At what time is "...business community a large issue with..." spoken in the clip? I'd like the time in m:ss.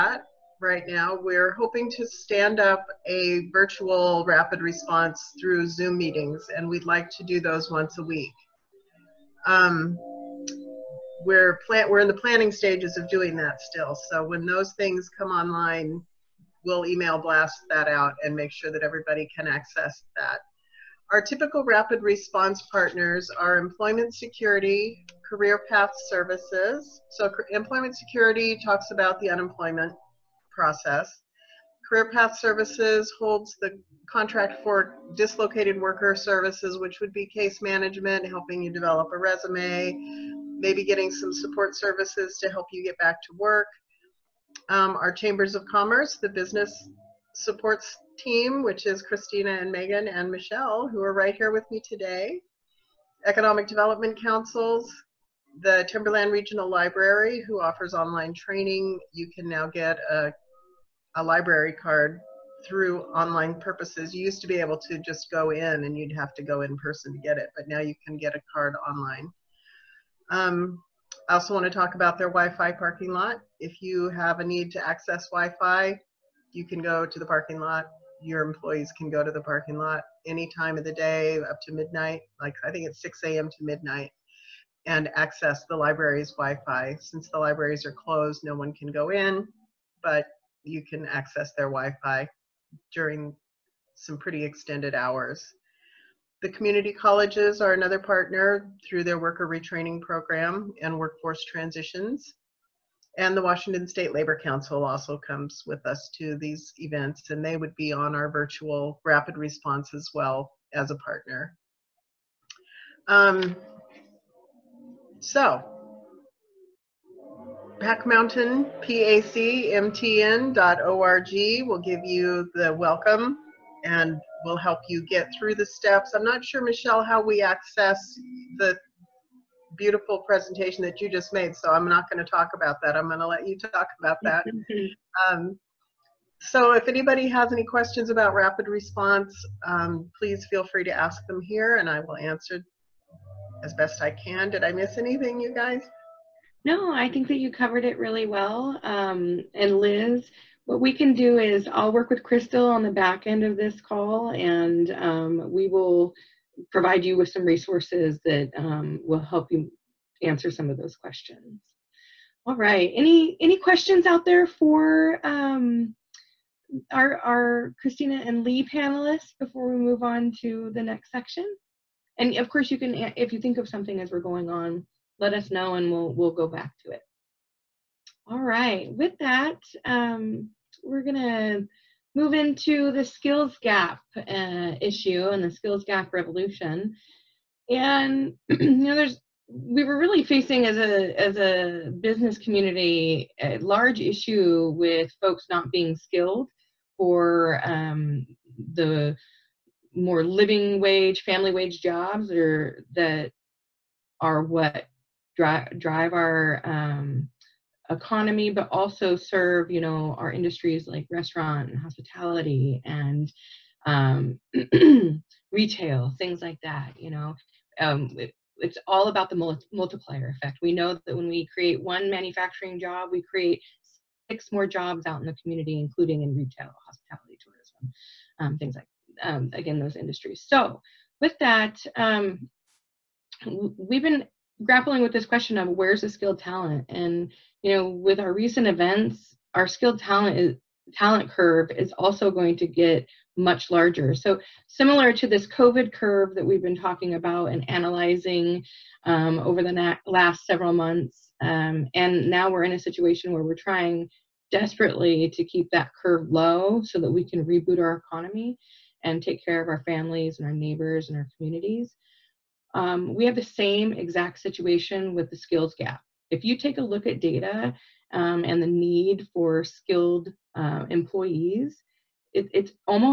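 3:11.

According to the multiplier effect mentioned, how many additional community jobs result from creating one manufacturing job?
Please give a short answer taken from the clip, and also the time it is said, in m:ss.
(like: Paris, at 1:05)
6, at 3:44.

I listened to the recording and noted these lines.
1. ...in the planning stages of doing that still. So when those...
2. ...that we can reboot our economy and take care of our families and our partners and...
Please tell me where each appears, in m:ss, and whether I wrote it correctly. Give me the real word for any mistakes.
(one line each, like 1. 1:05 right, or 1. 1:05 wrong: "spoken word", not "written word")
1. 0:11 right
2. 4:16 wrong: "neighbors", not "partners".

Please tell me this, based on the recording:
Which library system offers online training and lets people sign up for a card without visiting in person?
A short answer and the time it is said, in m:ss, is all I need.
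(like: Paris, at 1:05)
Timberland Regional Library, at 0:55.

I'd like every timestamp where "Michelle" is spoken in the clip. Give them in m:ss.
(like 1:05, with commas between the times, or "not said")
0:50, 2:06.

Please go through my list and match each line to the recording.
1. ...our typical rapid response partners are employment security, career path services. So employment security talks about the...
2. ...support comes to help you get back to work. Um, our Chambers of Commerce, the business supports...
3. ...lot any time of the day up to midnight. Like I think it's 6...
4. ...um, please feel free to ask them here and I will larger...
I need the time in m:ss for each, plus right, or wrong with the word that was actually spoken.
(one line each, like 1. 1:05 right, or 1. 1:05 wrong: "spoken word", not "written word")
1. 0:21 right
2. 0:41 wrong: "services", not "comes"
3. 1:19 right
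4. 2:19 wrong: "answer", not "larger".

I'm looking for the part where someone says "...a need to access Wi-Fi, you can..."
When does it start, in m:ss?
1:14.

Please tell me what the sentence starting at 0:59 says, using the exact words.
You can now get a, a library card through online purposes.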